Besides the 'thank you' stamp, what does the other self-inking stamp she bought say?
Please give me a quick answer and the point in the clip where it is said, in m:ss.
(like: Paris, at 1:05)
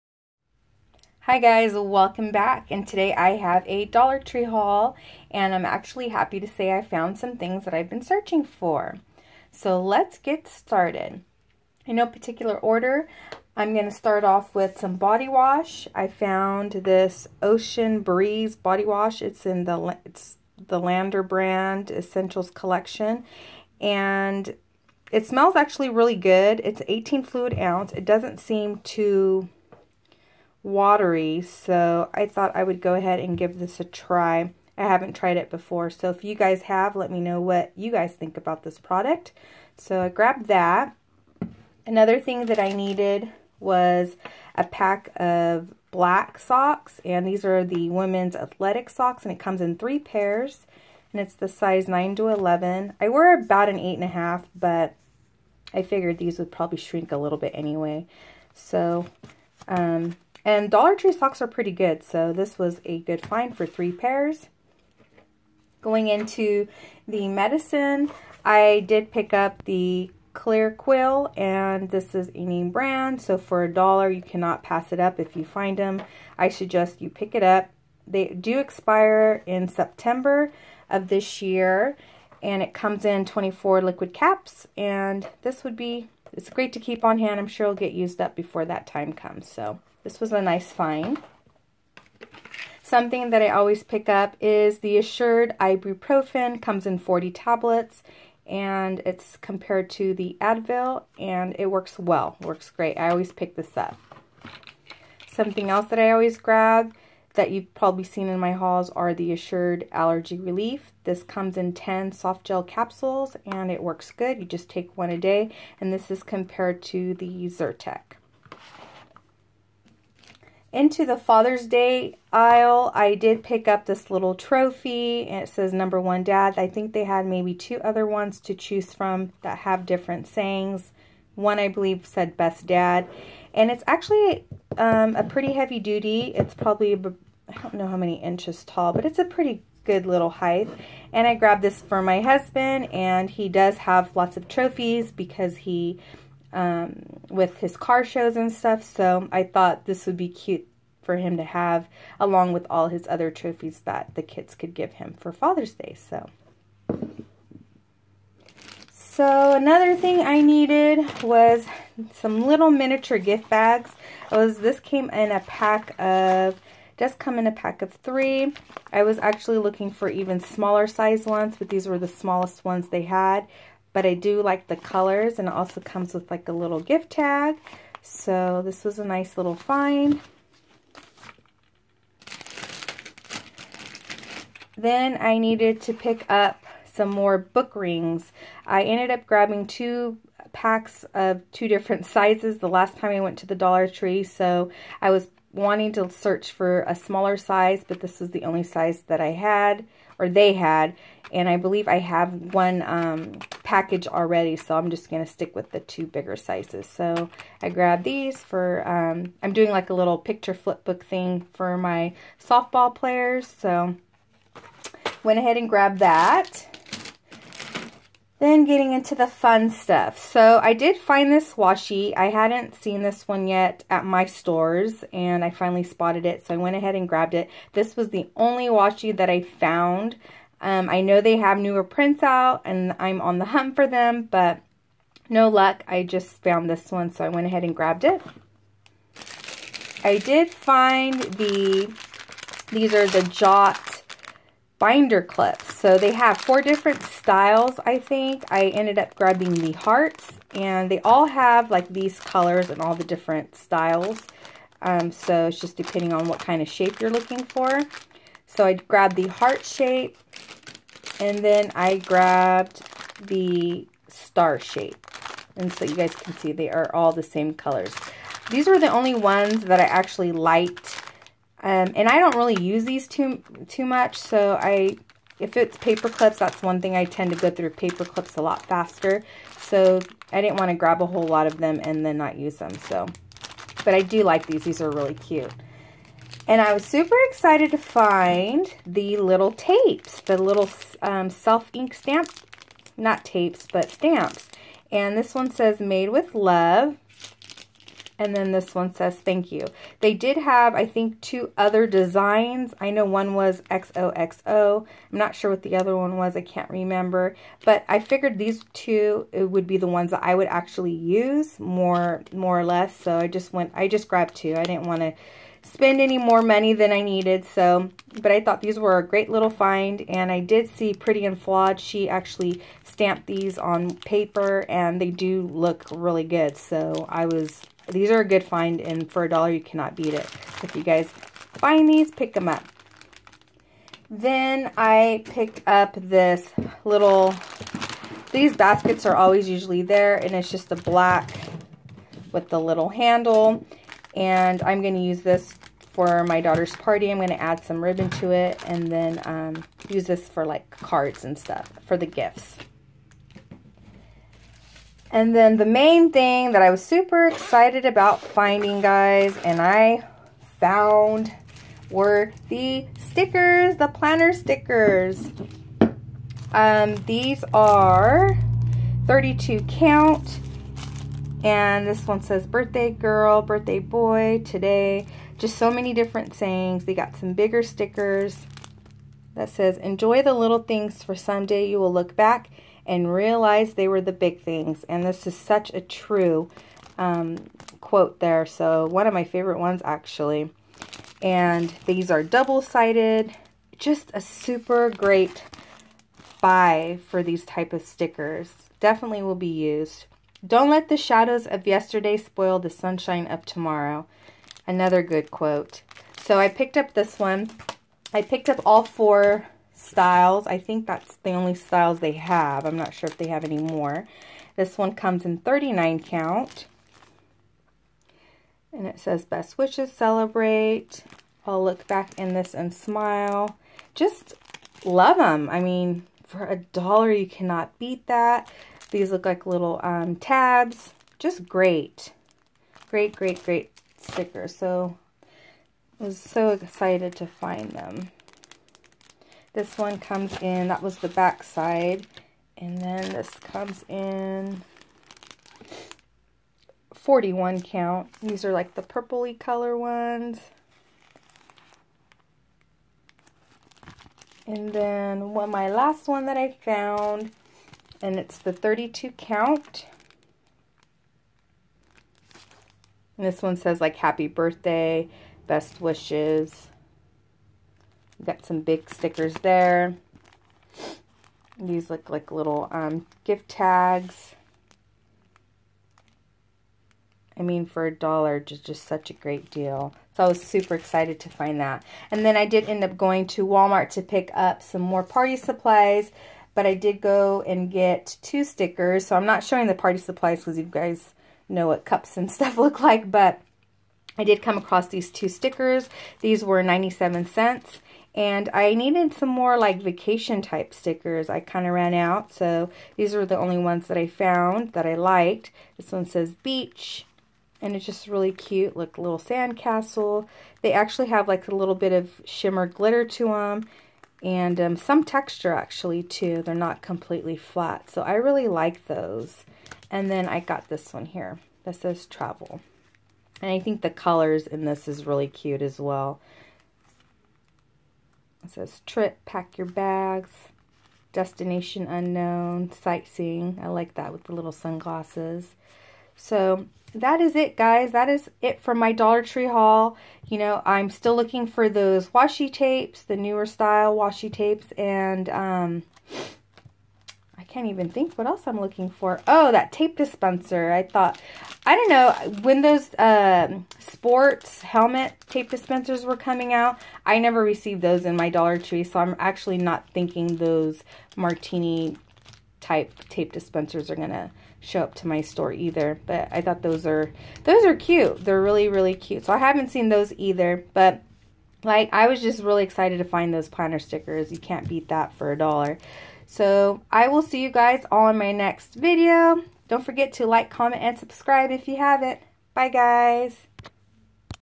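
Made with love, at 4:55.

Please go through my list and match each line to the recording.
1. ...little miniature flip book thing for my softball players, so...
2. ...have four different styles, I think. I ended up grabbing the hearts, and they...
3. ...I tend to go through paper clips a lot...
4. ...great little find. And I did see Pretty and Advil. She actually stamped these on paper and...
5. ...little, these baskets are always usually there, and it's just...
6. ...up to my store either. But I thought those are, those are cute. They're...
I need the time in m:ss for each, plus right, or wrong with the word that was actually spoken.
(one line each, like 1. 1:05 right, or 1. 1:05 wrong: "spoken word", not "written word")
1. 3:29 wrong: "picture", not "miniature"
2. 4:06 right
3. 4:36 right
4. 5:19 wrong: "Flawed", not "Advil"
5. 5:36 right
6. 9:24 right.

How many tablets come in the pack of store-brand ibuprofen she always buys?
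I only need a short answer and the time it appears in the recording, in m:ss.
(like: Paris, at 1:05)
40, at 1:36.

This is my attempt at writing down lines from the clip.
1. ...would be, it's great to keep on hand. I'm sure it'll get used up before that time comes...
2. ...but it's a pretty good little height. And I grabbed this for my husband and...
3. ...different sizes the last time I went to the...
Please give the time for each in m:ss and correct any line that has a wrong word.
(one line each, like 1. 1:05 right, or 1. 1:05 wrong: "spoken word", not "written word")
1. 1:25 right
2. 2:18 right
3. 3:11 right.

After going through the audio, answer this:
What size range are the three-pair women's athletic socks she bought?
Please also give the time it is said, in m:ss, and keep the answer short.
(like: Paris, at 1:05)
9 to 11, at 0:51.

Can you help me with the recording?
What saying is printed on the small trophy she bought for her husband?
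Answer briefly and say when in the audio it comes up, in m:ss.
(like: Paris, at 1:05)
Number one dad, at 2:05.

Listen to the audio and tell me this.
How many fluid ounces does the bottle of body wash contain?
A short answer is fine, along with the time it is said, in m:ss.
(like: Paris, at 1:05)
18, at 0:26.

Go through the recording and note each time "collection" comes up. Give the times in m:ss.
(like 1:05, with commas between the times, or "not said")
0:22.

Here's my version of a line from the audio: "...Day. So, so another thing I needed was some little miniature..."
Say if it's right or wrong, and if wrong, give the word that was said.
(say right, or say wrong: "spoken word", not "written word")
right.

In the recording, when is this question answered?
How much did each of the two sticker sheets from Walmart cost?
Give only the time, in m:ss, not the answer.
8:16.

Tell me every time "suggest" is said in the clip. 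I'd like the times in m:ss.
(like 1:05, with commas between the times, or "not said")
1:16.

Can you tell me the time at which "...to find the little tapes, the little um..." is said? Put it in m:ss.
4:47.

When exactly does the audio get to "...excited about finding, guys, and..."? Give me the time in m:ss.
5:57.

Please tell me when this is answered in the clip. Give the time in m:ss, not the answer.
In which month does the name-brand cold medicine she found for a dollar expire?
1:19.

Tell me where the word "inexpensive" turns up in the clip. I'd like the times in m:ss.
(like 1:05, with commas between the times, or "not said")
not said.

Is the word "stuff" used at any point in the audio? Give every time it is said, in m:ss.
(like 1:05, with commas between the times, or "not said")
2:28, 3:39, 5:51, 8:12.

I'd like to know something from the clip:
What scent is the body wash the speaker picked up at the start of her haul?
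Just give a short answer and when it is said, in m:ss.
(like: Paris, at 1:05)
Ocean Breeze, at 0:17.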